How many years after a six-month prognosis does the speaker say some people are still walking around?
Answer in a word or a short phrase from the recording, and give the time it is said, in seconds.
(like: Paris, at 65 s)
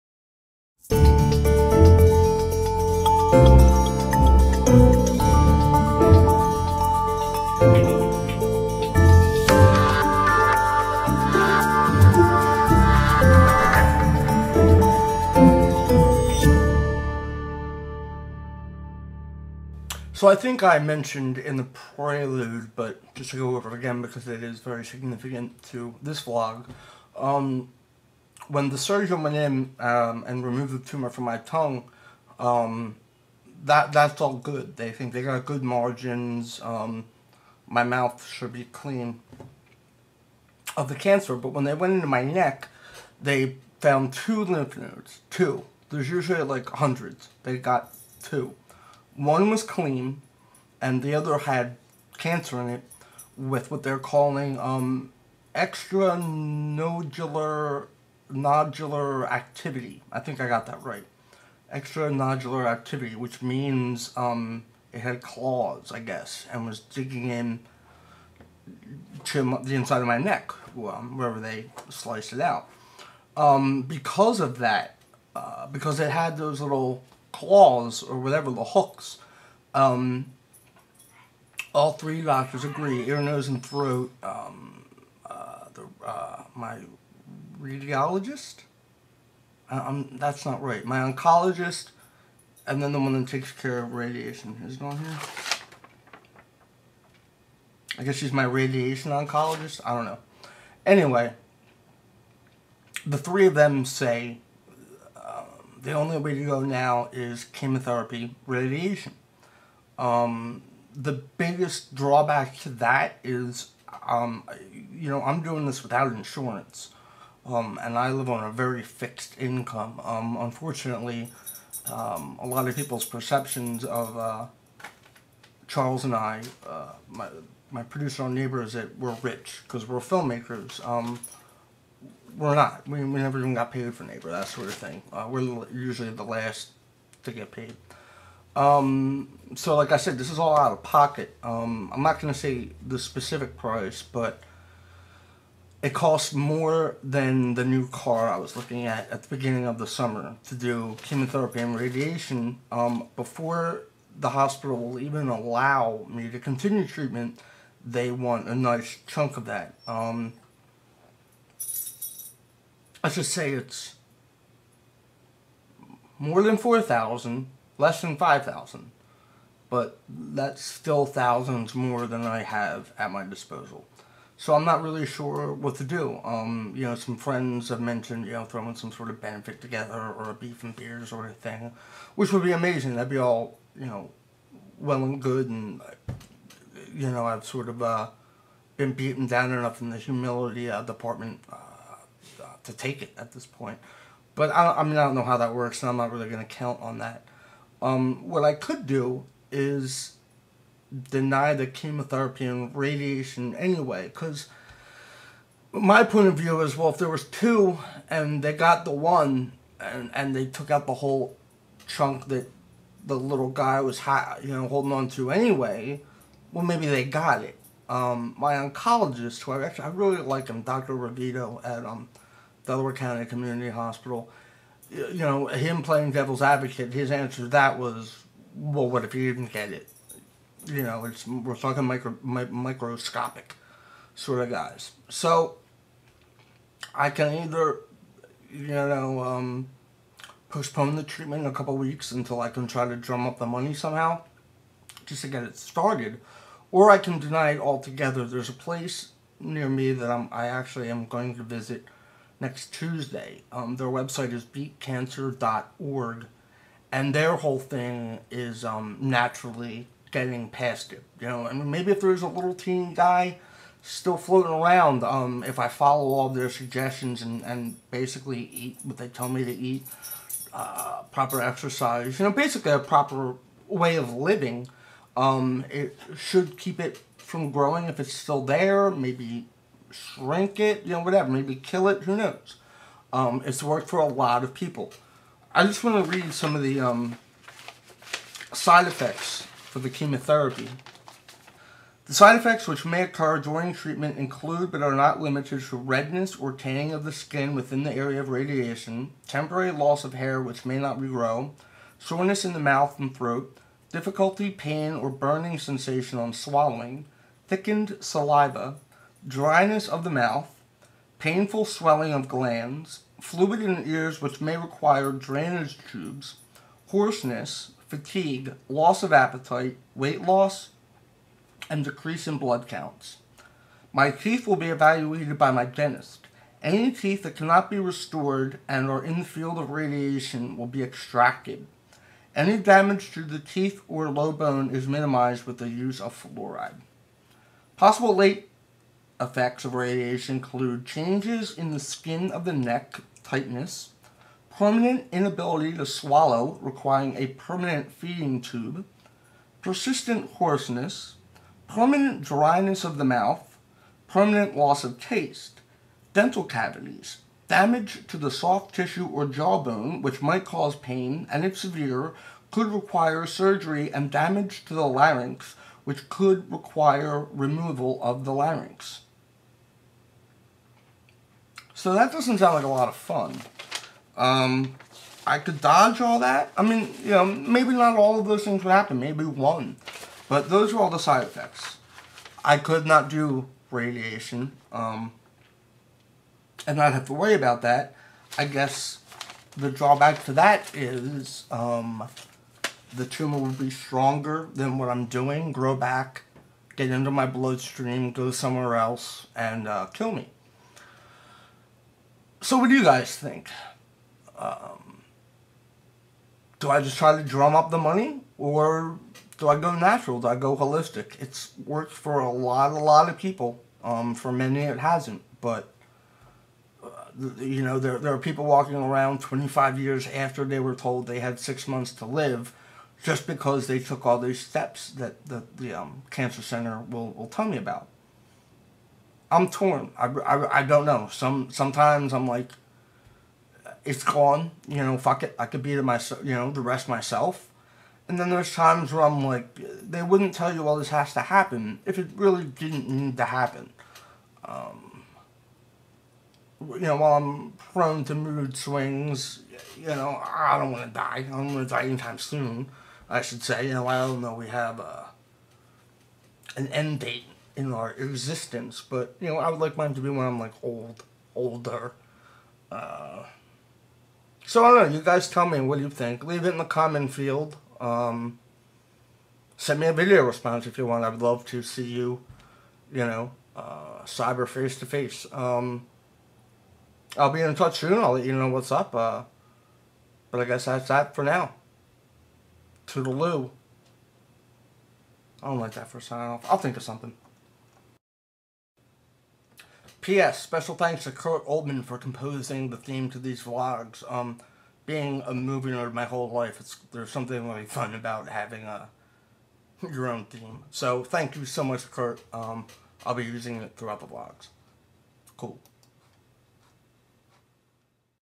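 25, at 419 s.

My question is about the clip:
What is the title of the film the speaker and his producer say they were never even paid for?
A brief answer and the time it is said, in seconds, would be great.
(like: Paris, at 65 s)
Neighbor, at 134 s.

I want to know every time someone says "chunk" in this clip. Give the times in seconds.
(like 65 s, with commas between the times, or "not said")
159 s, 211 s.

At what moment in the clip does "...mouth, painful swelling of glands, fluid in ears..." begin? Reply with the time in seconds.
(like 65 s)
310 s.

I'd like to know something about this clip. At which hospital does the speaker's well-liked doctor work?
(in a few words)
Delaware County Community Hospital.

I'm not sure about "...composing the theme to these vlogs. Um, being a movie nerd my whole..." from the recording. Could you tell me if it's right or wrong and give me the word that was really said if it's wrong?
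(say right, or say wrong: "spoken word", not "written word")
right.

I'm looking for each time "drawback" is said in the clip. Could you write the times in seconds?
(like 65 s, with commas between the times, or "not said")
111 s, 389 s.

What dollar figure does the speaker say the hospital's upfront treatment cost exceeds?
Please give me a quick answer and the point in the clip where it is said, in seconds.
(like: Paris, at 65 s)
4,000, at 166 s.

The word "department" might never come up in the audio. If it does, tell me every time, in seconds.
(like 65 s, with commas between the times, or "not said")
190 s.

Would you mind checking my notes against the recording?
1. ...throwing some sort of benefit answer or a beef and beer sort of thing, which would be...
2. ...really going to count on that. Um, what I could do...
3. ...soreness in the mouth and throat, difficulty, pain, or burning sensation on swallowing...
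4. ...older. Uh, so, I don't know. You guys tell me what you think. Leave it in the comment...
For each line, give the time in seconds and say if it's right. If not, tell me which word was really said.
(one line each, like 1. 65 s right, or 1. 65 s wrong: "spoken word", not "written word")
1. 178 s wrong: "together", not "answer"
2. 196 s right
3. 301 s right
4. 461 s right.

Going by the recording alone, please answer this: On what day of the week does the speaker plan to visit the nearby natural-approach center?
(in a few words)
Tuesday.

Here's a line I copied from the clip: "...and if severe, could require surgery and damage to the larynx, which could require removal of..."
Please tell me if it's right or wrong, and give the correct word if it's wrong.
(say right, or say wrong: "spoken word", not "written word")
right.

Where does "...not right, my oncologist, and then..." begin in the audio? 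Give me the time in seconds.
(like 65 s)
90 s.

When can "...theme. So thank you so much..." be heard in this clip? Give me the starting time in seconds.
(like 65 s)
500 s.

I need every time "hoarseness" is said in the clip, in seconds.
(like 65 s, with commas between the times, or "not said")
316 s, 350 s.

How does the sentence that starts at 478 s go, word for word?
Uh, but I guess that's that for now.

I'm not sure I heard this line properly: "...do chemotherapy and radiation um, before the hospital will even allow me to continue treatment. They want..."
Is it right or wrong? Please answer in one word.
right.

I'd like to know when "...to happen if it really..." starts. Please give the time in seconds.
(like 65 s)
441 s.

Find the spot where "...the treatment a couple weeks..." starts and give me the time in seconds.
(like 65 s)
240 s.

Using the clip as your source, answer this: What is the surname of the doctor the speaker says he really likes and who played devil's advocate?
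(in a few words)
Rogito.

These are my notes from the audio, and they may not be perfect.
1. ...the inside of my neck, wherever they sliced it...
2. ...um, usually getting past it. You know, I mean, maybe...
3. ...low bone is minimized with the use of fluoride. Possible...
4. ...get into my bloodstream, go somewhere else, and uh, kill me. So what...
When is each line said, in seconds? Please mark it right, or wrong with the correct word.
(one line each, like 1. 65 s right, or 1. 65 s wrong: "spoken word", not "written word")
1. 69 s right
2. 258 s wrong: "naturally", not "usually"
3. 334 s right
4. 396 s right.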